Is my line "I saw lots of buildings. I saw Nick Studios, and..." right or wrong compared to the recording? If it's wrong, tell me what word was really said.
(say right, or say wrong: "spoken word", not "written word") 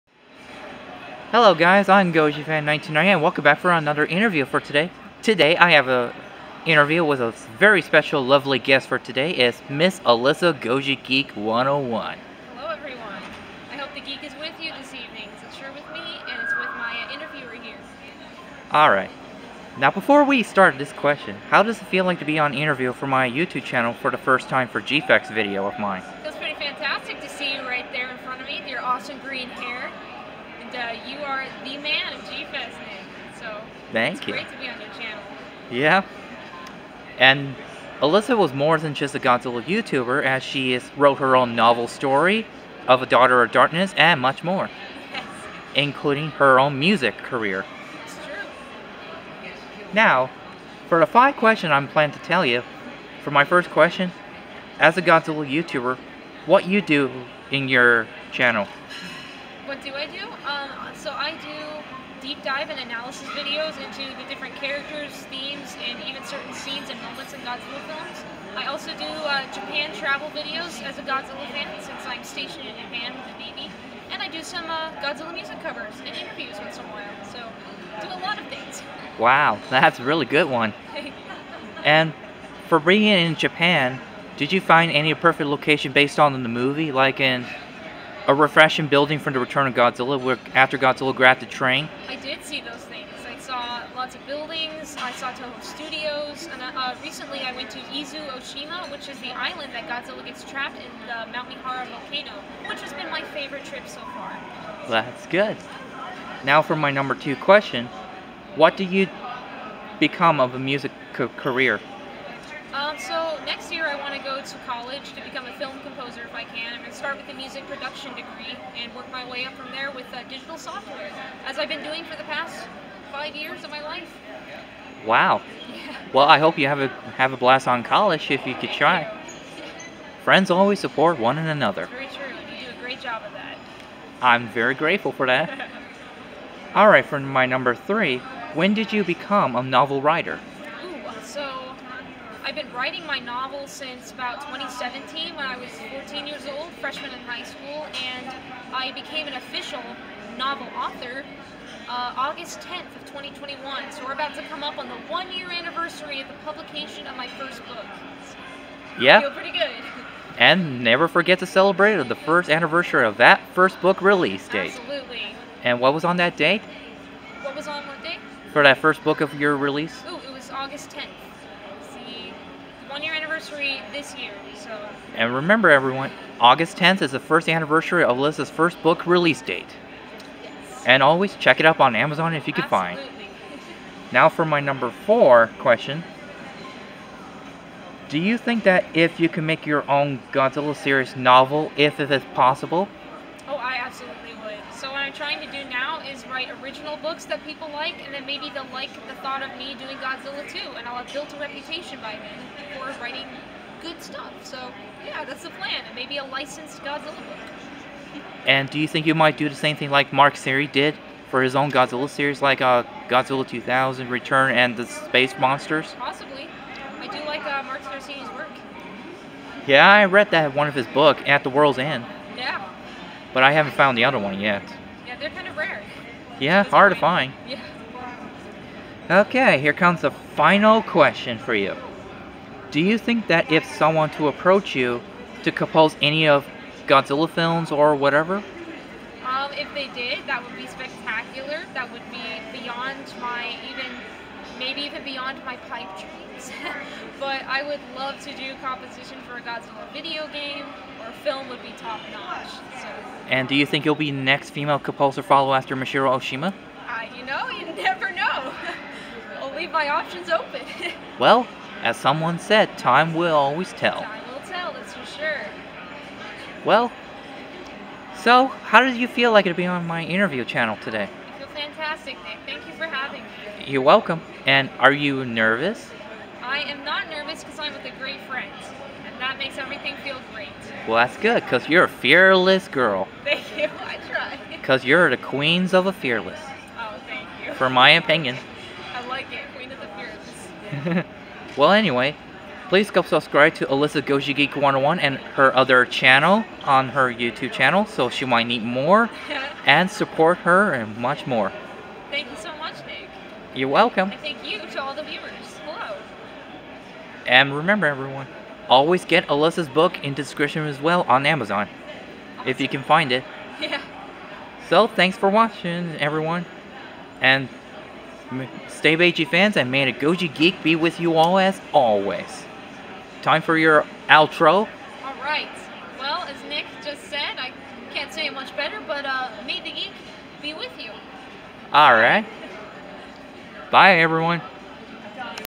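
wrong: "Toho", not "Nick".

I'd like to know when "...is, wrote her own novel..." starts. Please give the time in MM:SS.
00:40.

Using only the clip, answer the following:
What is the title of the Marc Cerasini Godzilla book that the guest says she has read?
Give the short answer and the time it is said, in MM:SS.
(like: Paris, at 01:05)
At the World's End, at 03:41.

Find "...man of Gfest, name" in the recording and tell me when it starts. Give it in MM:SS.
00:31.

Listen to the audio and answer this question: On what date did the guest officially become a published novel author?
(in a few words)
August 10, 2021.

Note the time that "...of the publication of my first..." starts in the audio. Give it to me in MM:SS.
02:36.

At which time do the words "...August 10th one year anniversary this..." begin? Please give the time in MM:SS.
02:50.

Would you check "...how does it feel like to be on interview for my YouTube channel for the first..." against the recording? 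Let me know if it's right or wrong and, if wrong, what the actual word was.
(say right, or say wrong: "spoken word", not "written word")
right.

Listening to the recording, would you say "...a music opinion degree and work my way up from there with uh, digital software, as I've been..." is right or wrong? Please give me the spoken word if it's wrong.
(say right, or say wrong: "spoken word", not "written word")
wrong: "production", not "opinion".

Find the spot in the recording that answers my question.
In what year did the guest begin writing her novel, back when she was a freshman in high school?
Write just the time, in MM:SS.
02:24.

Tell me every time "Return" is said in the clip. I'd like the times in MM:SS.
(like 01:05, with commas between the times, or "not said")
01:29, 03:34.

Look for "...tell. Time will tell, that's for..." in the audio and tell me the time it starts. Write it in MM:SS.
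04:23.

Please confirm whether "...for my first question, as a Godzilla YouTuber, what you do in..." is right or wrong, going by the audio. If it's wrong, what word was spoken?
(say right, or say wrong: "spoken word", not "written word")
right.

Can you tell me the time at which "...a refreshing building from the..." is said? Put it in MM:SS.
01:28.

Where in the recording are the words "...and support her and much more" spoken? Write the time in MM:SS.
04:59.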